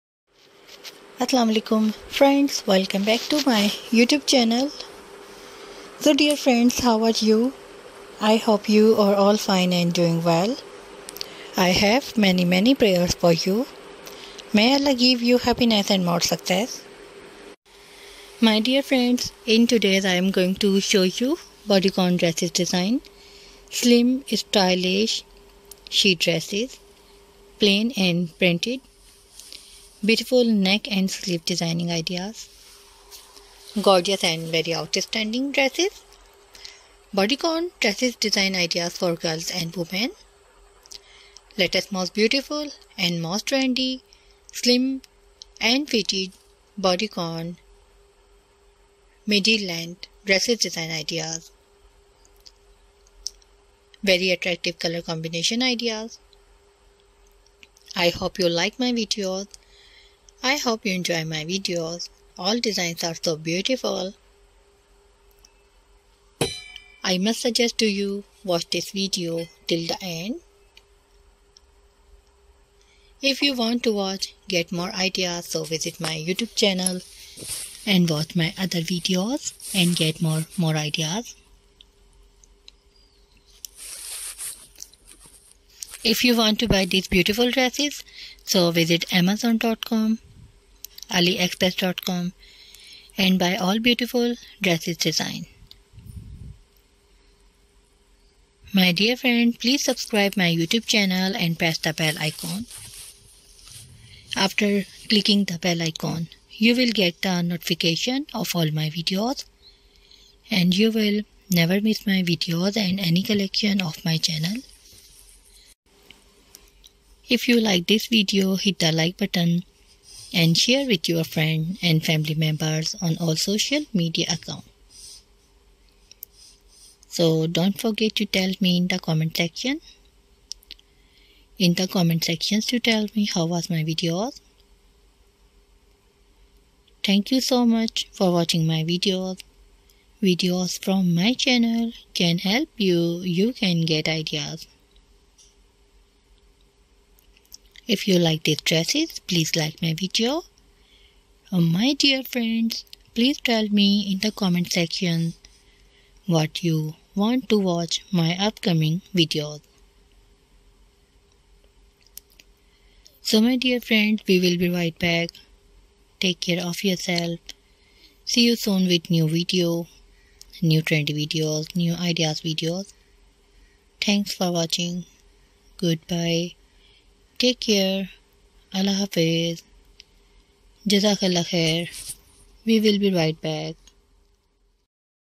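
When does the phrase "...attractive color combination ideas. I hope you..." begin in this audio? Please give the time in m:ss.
0:54.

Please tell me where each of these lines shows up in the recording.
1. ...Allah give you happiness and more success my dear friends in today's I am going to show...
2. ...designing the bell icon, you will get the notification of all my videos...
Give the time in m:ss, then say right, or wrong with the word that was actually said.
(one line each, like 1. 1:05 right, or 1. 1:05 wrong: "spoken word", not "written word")
1. 0:14 right
2. 1:45 wrong: "clicking", not "designing".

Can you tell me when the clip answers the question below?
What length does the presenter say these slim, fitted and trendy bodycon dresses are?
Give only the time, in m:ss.
0:49.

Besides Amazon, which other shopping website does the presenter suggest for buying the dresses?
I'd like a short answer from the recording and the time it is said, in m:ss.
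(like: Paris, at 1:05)
aliexpress.com, at 1:31.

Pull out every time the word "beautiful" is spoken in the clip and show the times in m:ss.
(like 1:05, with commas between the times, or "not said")
0:30, 0:42, 1:03, 1:27, 1:33.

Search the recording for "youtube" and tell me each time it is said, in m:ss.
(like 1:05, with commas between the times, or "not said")
0:03, 1:16, 1:40.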